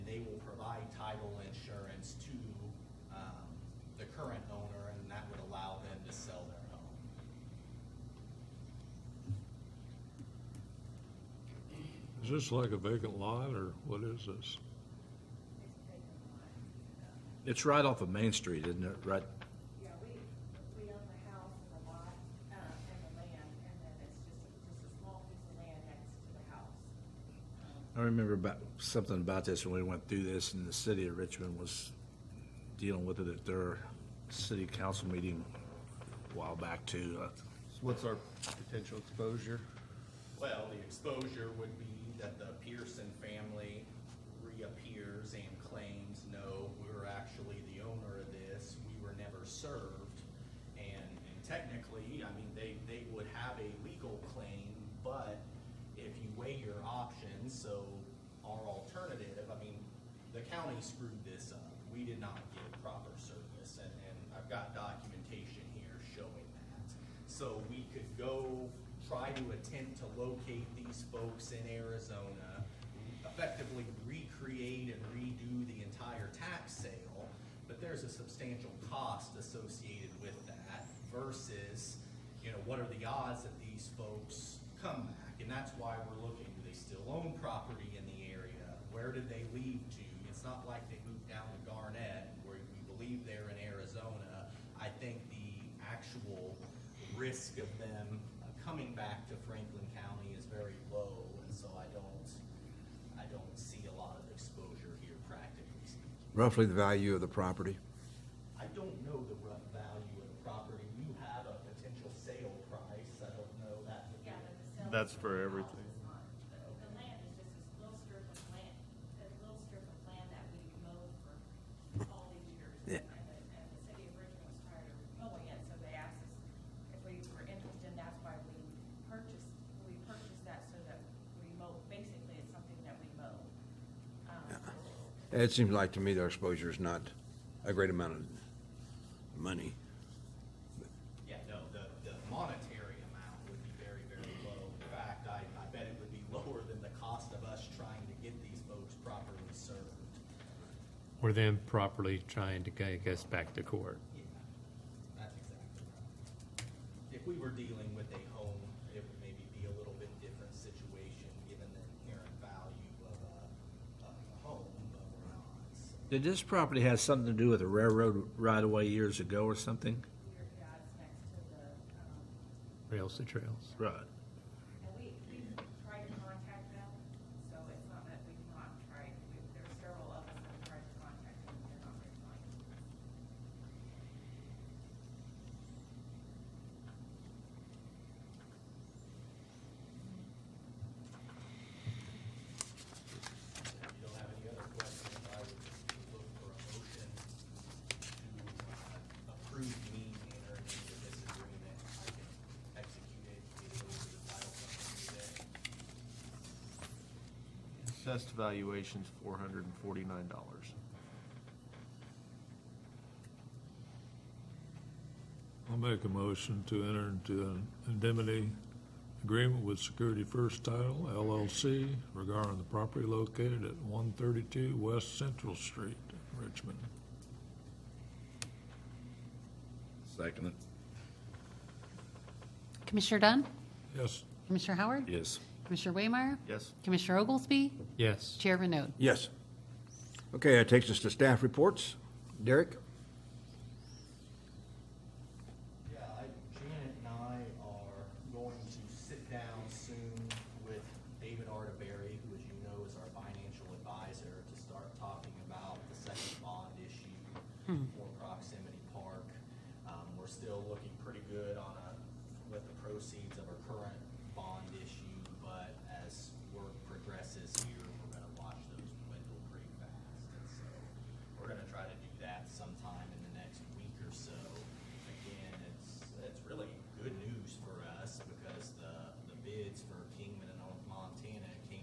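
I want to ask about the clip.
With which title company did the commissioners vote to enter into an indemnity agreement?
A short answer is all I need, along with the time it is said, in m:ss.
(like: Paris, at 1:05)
Security First Title LLC, at 3:39.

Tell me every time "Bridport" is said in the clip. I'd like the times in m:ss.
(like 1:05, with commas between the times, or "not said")
not said.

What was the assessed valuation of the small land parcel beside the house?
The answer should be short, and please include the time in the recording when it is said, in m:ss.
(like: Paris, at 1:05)
$449, at 3:29.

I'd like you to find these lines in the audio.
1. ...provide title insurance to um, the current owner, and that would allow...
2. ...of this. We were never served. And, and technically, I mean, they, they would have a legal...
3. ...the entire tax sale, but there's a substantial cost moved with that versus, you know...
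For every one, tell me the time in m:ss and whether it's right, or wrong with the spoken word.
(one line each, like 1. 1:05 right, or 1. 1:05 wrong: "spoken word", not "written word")
1. 0:00 right
2. 0:48 right
3. 1:15 wrong: "associated", not "moved".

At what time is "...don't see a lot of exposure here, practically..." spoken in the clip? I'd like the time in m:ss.
1:43.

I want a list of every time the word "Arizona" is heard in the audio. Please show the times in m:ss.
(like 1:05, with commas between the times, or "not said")
1:11, 1:33.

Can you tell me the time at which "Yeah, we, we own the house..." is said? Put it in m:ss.
0:19.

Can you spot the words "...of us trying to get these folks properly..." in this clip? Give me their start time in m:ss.
2:27.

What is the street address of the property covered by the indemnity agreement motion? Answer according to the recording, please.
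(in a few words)
132 West Central Street.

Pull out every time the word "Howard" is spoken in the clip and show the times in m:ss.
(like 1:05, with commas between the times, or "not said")
3:54.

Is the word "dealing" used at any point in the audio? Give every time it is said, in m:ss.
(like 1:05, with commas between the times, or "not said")
0:32, 2:37.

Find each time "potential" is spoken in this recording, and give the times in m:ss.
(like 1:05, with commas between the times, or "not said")
0:38, 1:51.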